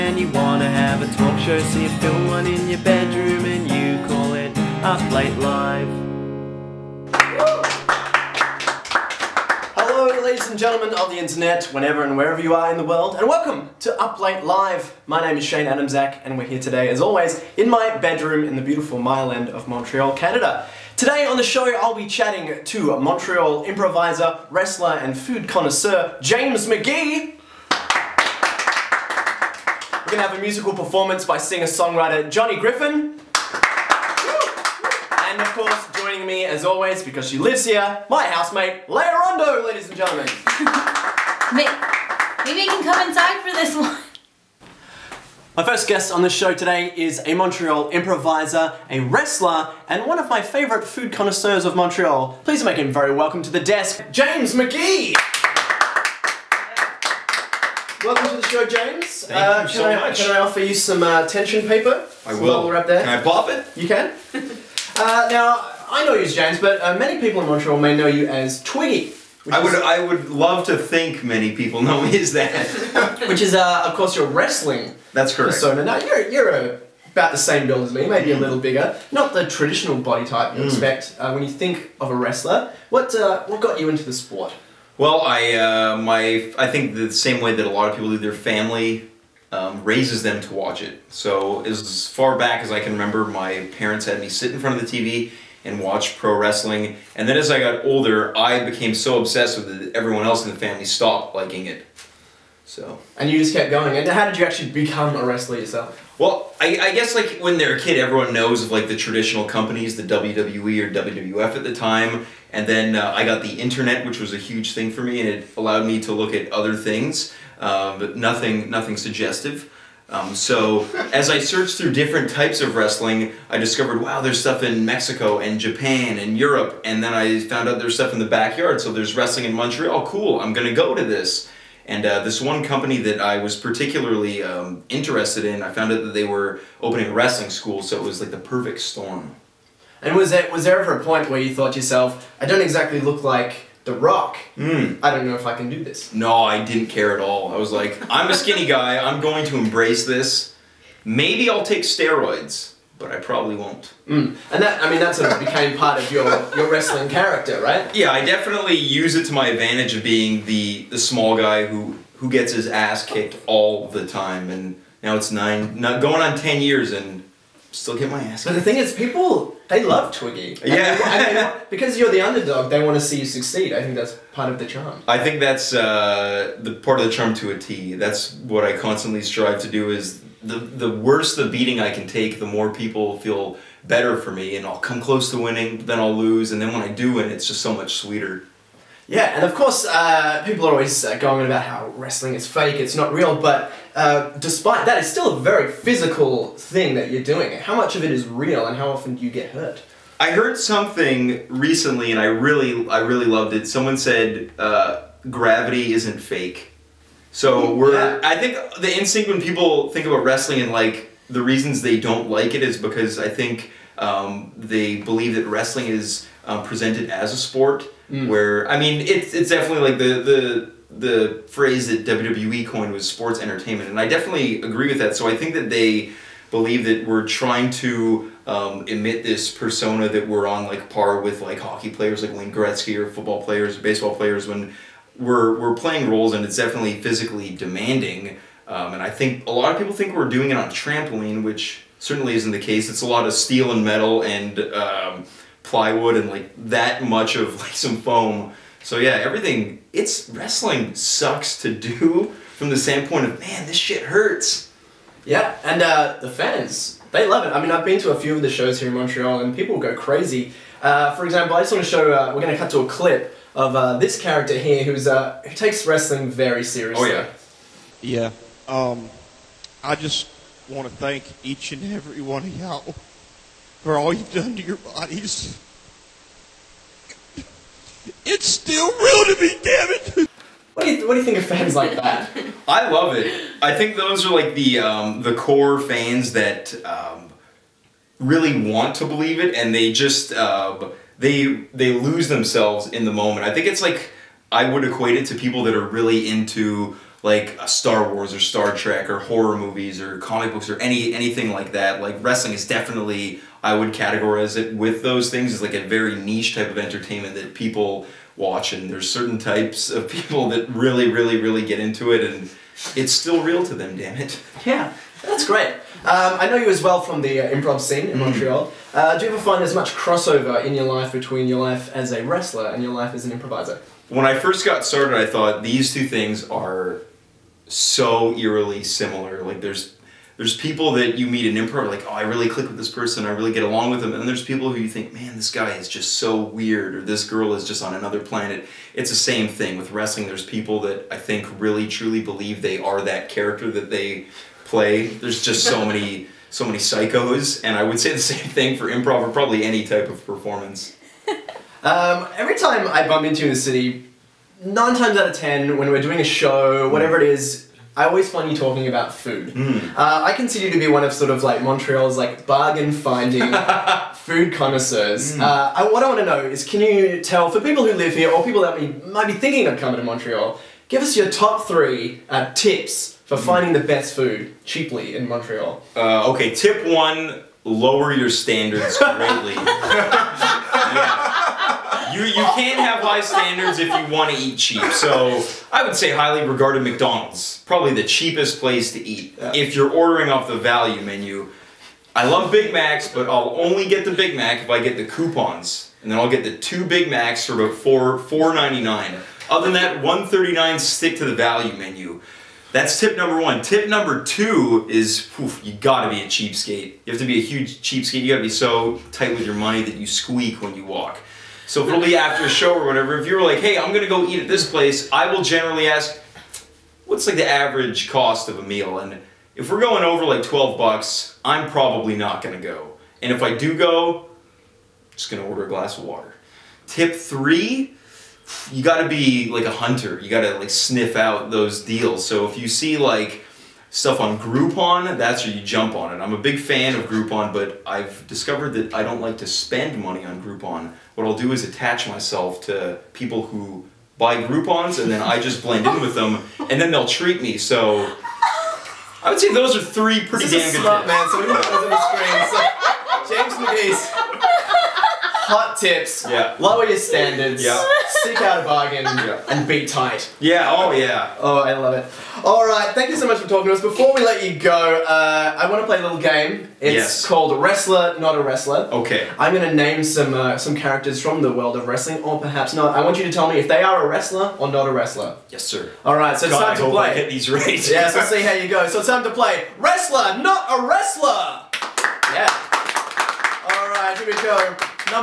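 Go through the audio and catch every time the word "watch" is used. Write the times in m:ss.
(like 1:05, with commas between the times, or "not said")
1:30, 1:35, 5:08.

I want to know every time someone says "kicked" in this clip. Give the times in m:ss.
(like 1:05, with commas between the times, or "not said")
2:43, 2:48.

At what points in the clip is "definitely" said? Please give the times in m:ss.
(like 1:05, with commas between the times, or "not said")
2:38, 3:39, 3:44, 3:56, 5:02.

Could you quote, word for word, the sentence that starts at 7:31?
So we put those on the screen.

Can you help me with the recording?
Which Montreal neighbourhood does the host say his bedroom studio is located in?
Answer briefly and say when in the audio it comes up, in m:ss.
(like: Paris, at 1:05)
Mile End, at 0:18.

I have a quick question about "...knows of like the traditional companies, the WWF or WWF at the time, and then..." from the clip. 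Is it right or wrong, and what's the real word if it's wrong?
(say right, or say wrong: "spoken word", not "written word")
wrong: "WWE", not "WWF".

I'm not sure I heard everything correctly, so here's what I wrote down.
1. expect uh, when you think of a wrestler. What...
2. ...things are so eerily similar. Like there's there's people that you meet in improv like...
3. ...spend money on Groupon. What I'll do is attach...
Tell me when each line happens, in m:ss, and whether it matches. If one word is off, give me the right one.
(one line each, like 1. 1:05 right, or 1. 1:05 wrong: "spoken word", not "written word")
1. 1:20 right
2. 5:26 right
3. 7:19 right.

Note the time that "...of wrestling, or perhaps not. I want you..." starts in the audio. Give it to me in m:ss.
7:51.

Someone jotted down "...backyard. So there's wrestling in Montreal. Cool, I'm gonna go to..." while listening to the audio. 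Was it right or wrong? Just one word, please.
right.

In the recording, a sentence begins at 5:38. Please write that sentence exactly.
It's the same thing with wrestling.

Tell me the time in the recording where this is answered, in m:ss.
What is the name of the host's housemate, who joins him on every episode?
0:38.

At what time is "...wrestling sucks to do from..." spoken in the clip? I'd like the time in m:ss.
4:10.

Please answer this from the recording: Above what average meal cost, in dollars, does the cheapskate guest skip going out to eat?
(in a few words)
12 dollars.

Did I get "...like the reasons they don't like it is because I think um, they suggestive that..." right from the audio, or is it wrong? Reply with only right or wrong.
wrong.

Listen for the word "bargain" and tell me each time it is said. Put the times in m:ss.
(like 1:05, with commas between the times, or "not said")
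6:02, 7:38.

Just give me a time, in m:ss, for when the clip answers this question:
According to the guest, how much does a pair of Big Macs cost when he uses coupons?
6:37.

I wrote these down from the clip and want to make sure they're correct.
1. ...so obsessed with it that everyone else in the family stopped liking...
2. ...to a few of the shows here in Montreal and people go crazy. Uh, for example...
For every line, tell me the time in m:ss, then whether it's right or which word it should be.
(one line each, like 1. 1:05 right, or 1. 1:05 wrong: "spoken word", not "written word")
1. 1:38 right
2. 4:17 right.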